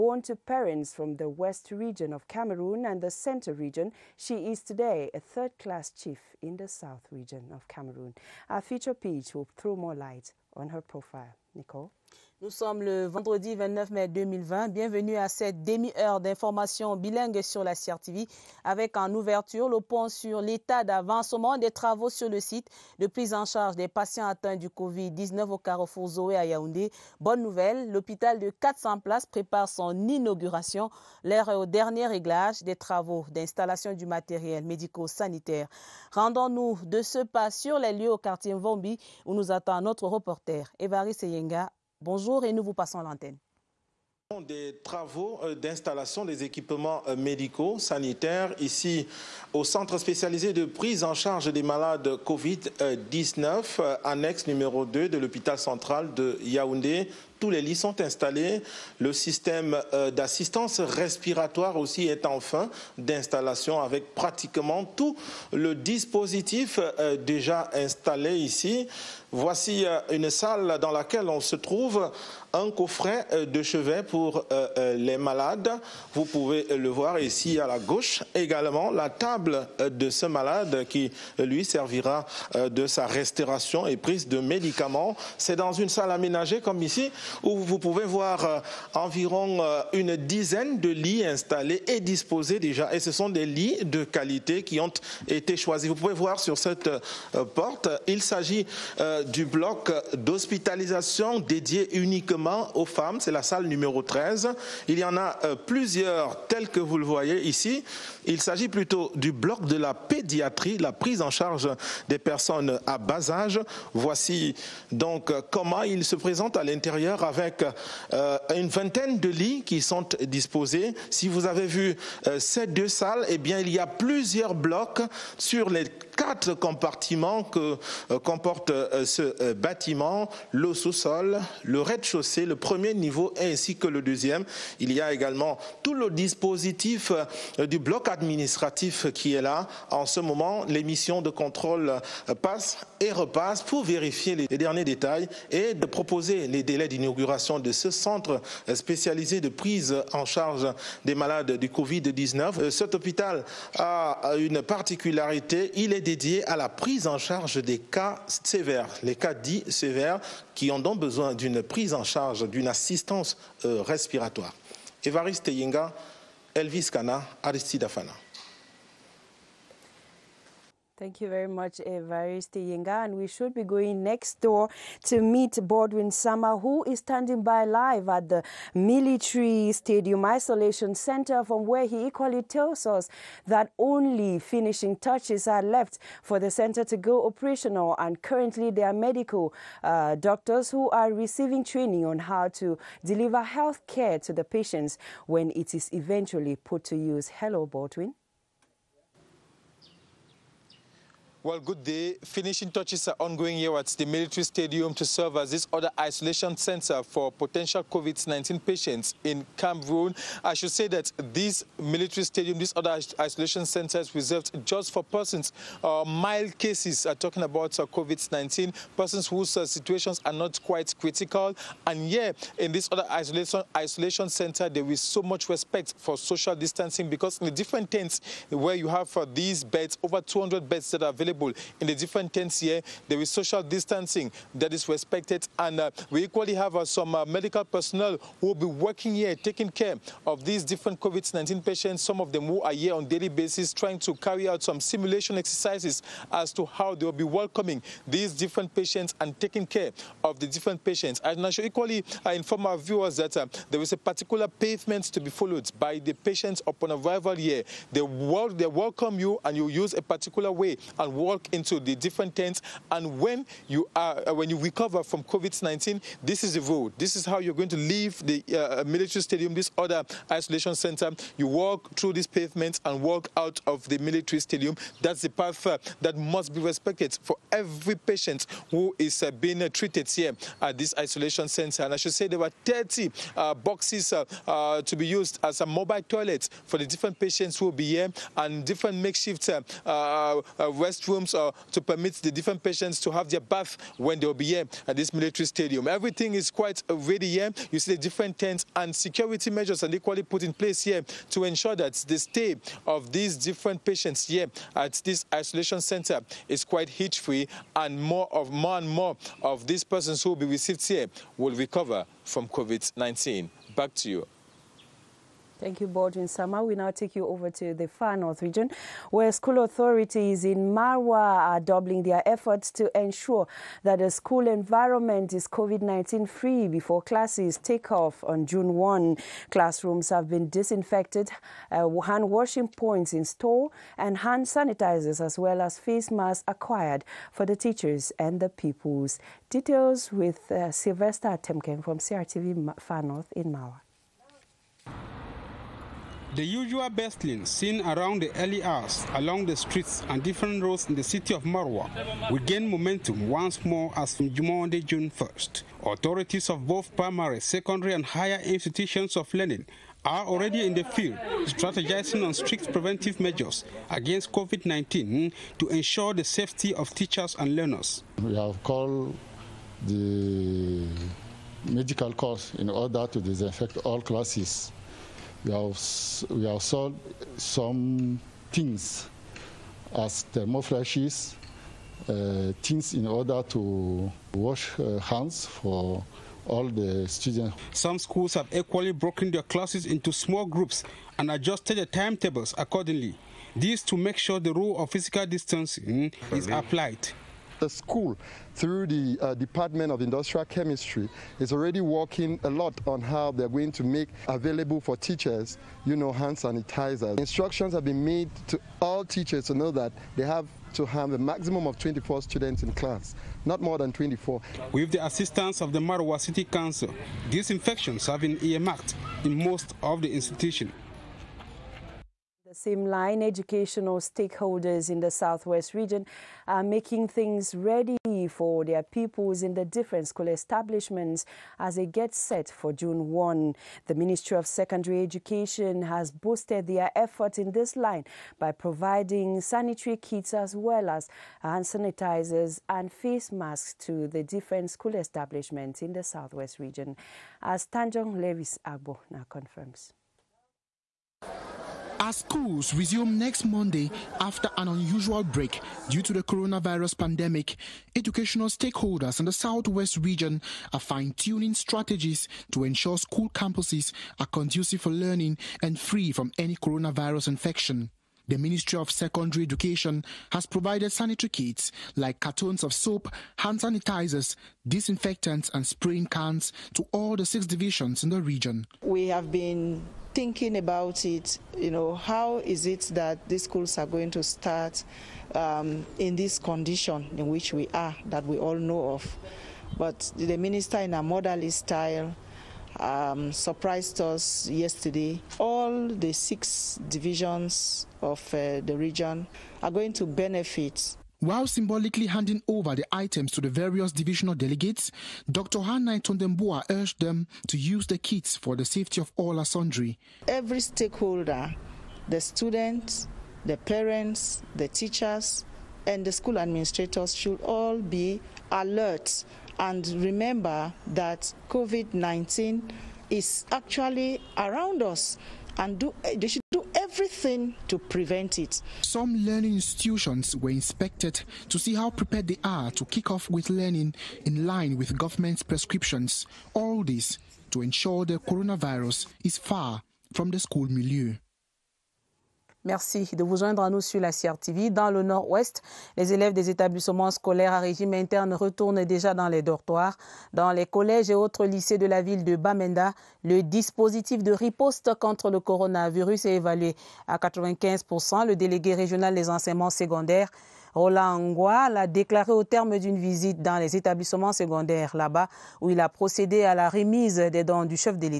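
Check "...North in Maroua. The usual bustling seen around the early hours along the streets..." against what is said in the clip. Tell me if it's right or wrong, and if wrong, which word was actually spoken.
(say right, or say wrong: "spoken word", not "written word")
right.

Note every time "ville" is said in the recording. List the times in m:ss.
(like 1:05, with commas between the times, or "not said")
9:11.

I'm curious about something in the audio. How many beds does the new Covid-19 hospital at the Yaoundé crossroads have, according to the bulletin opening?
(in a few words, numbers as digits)
400.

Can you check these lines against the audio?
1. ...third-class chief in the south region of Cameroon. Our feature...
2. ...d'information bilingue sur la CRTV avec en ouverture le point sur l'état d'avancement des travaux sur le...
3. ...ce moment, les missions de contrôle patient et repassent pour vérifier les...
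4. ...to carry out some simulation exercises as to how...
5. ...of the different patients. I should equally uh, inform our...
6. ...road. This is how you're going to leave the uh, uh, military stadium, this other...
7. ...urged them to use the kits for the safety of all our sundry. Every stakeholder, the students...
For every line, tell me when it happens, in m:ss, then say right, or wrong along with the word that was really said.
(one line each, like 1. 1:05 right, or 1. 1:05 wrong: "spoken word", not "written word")
1. 0:05 right
2. 0:16 right
3. 2:20 wrong: "passent", not "patient"
4. 4:03 right
5. 4:10 right
6. 4:26 right
7. 8:26 right.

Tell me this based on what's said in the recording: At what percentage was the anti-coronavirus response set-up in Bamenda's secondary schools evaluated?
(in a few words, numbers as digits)
95%.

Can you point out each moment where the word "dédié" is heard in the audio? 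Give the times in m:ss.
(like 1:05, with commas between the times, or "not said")
1:41, 2:36.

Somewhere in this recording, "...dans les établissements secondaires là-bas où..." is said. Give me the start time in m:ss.
9:23.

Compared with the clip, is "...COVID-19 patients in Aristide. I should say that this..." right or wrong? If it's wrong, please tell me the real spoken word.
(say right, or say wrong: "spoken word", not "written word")
wrong: "Cameroon", not "Aristide".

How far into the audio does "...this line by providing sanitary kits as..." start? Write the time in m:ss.
7:17.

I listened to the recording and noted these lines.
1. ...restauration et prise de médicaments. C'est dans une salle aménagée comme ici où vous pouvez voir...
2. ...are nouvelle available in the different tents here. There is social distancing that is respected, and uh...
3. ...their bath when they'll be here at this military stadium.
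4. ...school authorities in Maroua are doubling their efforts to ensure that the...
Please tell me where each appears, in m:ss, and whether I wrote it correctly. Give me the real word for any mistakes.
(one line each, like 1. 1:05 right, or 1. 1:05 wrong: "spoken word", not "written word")
1. 1:23 right
2. 3:51 wrong: "available", not "nouvelle"
3. 4:53 right
4. 5:19 right.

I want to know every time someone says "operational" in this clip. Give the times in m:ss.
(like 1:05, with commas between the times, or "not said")
3:07.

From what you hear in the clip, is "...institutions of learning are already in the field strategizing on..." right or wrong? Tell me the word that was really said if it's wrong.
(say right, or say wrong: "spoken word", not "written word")
right.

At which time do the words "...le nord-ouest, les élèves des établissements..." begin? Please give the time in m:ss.
9:04.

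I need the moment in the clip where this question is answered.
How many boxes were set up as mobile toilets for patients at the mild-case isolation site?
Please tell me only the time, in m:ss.
4:42.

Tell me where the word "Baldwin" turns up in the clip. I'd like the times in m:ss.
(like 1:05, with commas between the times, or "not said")
2:55, 3:17, 5:15.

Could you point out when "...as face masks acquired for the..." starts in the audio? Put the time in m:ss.
5:35.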